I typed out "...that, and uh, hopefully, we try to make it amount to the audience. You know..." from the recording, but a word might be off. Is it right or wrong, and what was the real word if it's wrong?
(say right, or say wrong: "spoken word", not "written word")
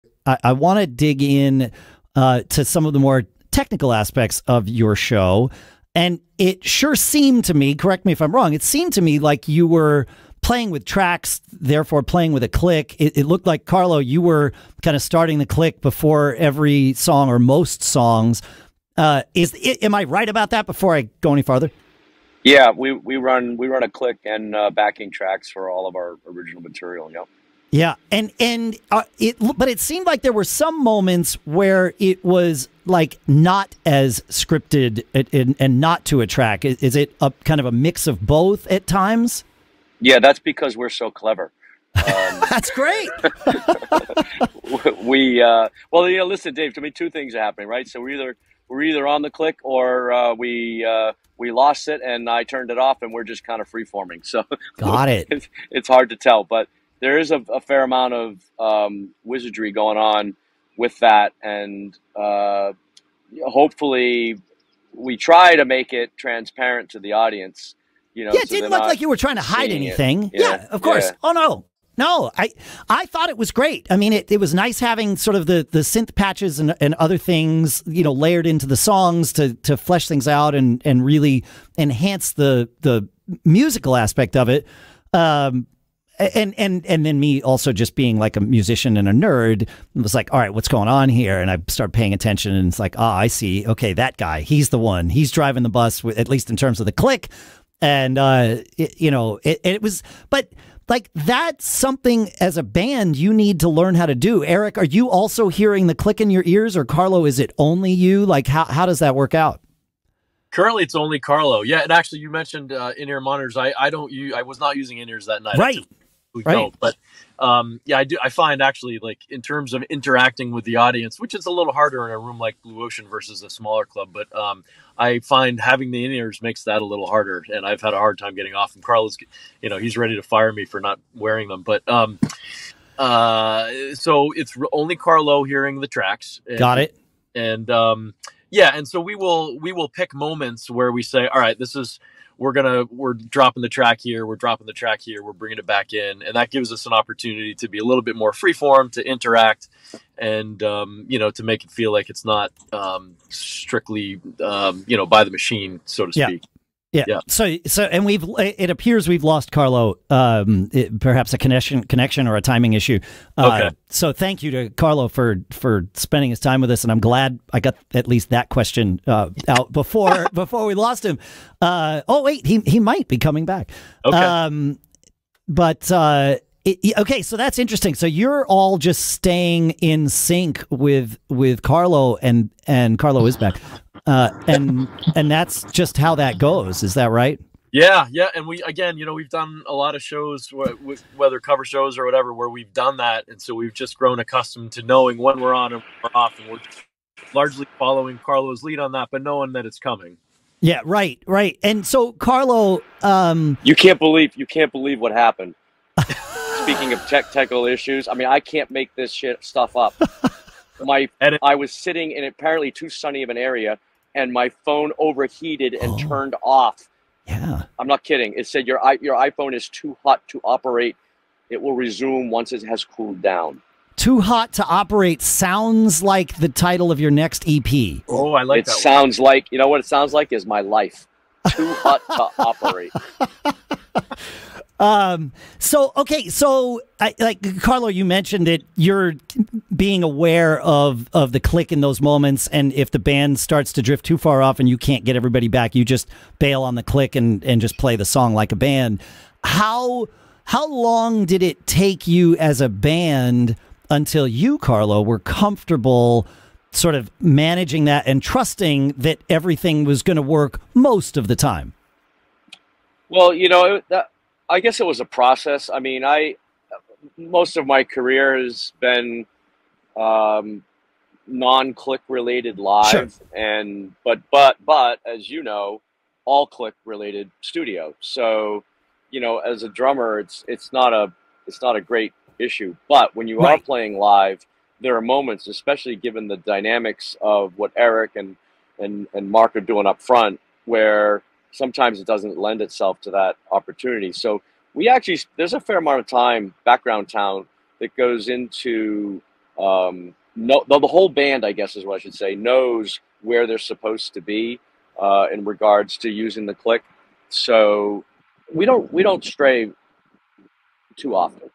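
wrong: "transparent", not "amount".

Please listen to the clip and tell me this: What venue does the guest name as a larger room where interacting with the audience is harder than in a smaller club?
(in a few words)
Blue Ocean.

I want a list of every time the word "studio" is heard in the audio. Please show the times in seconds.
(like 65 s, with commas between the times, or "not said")
277 s.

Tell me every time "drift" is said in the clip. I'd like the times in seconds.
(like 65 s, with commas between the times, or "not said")
243 s.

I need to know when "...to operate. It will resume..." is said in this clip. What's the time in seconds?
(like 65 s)
220 s.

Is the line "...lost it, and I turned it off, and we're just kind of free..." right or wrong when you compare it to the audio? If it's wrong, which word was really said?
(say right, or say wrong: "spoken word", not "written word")
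right.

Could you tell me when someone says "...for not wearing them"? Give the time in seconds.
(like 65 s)
130 s.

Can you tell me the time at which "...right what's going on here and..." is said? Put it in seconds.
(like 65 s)
90 s.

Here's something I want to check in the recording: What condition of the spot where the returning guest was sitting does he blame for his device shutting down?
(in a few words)
Too sunny.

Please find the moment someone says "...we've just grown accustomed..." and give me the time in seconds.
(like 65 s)
193 s.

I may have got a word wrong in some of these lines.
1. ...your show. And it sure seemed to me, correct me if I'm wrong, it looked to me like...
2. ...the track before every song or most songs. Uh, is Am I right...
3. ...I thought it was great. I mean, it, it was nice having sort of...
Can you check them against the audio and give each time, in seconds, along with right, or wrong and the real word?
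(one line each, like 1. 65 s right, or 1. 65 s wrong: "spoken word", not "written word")
1. 4 s wrong: "seemed", not "looked"
2. 15 s wrong: "click", not "track"
3. 72 s right.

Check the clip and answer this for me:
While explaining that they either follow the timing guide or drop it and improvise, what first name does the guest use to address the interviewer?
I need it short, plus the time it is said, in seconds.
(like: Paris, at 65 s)
Dave, at 46 s.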